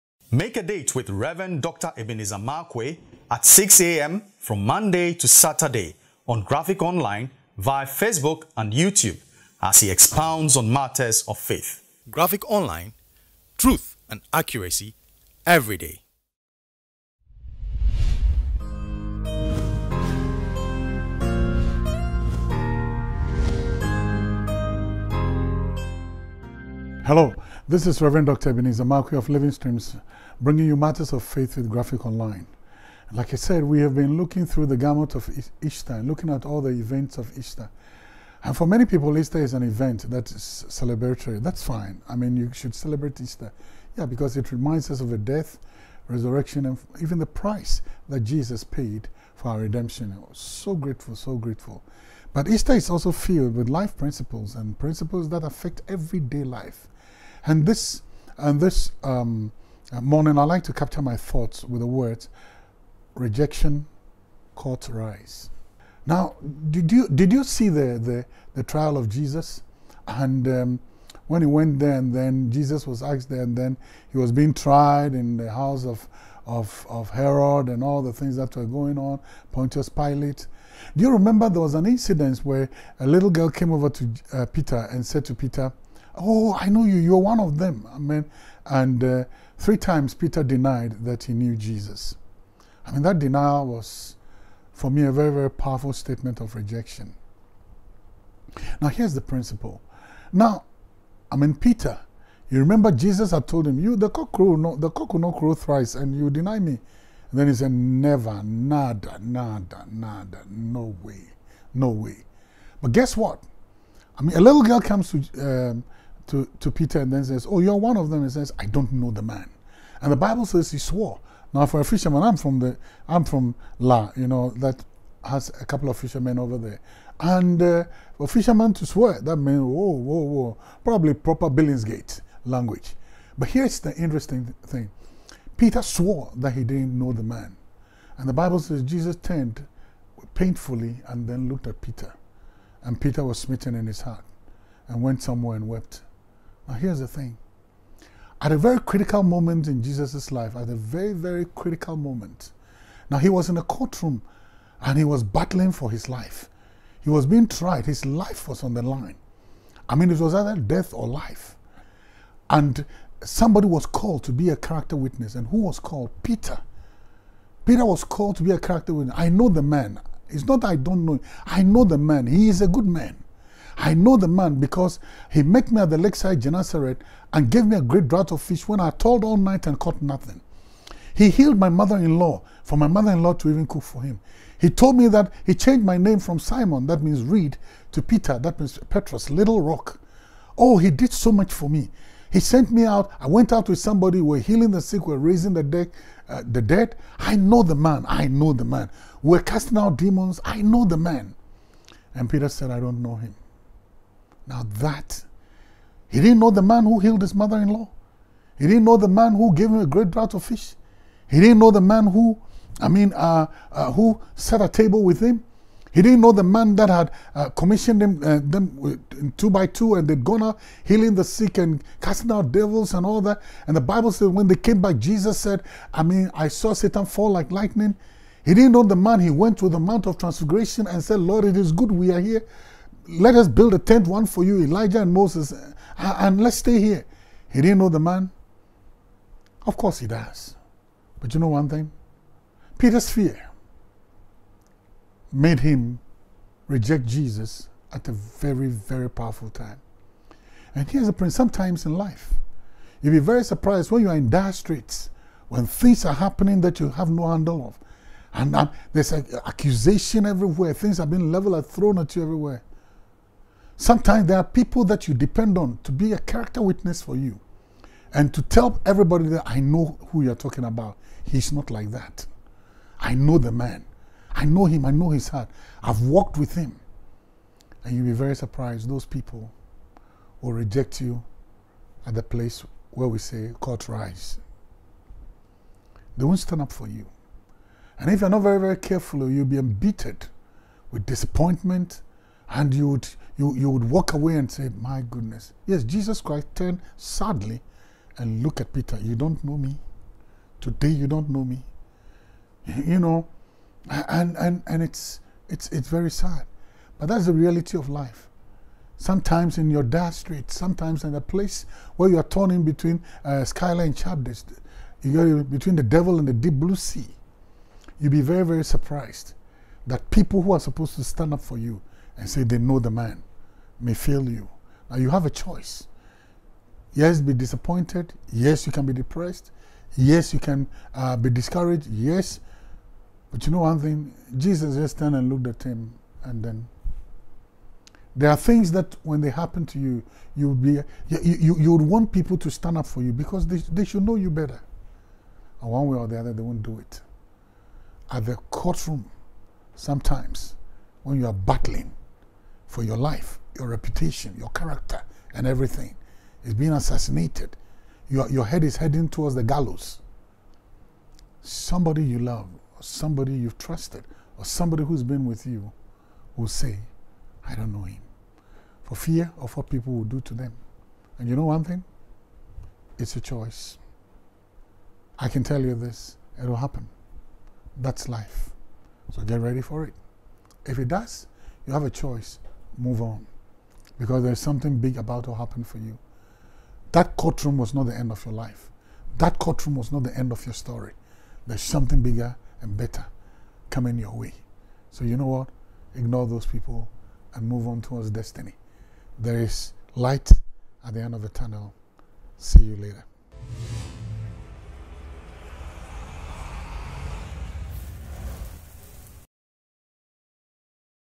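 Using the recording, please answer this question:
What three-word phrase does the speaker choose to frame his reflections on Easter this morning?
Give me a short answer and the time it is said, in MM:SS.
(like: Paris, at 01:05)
Rejection court rise, at 01:03.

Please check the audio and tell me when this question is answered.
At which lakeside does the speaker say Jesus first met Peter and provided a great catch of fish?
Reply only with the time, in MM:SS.
02:56.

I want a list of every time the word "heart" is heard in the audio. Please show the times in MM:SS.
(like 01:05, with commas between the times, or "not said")
02:24, 04:35.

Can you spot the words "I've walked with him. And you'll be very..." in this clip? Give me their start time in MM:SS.
04:35.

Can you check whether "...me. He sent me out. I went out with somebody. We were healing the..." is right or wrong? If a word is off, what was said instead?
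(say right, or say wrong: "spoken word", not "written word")
right.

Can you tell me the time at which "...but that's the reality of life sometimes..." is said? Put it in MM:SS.
05:06.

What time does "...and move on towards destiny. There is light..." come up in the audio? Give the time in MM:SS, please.
06:37.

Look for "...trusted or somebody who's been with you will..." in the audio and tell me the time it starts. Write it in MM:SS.
06:03.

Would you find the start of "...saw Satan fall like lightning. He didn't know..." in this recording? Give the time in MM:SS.
03:46.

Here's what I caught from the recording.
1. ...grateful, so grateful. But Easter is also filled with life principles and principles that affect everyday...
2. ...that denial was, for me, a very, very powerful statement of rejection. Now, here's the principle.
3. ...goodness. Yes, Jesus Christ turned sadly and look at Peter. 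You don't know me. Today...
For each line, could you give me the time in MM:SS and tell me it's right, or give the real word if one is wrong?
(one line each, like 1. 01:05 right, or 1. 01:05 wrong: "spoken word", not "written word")
1. 00:50 right
2. 01:33 right
3. 04:55 right.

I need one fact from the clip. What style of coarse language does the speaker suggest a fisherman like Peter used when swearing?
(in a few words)
Billingsgate language.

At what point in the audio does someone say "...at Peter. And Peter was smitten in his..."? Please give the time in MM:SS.
02:21.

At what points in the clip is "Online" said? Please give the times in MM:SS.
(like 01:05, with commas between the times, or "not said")
00:06, 00:12, 00:32.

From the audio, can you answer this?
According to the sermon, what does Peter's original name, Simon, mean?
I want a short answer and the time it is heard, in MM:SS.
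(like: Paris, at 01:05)
Reed, at 03:07.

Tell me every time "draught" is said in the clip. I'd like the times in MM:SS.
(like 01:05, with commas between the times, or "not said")
02:58, 03:30.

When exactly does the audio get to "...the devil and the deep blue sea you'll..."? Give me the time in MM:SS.
05:15.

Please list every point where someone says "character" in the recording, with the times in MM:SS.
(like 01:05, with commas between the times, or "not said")
02:44, 02:48, 04:26, 05:54.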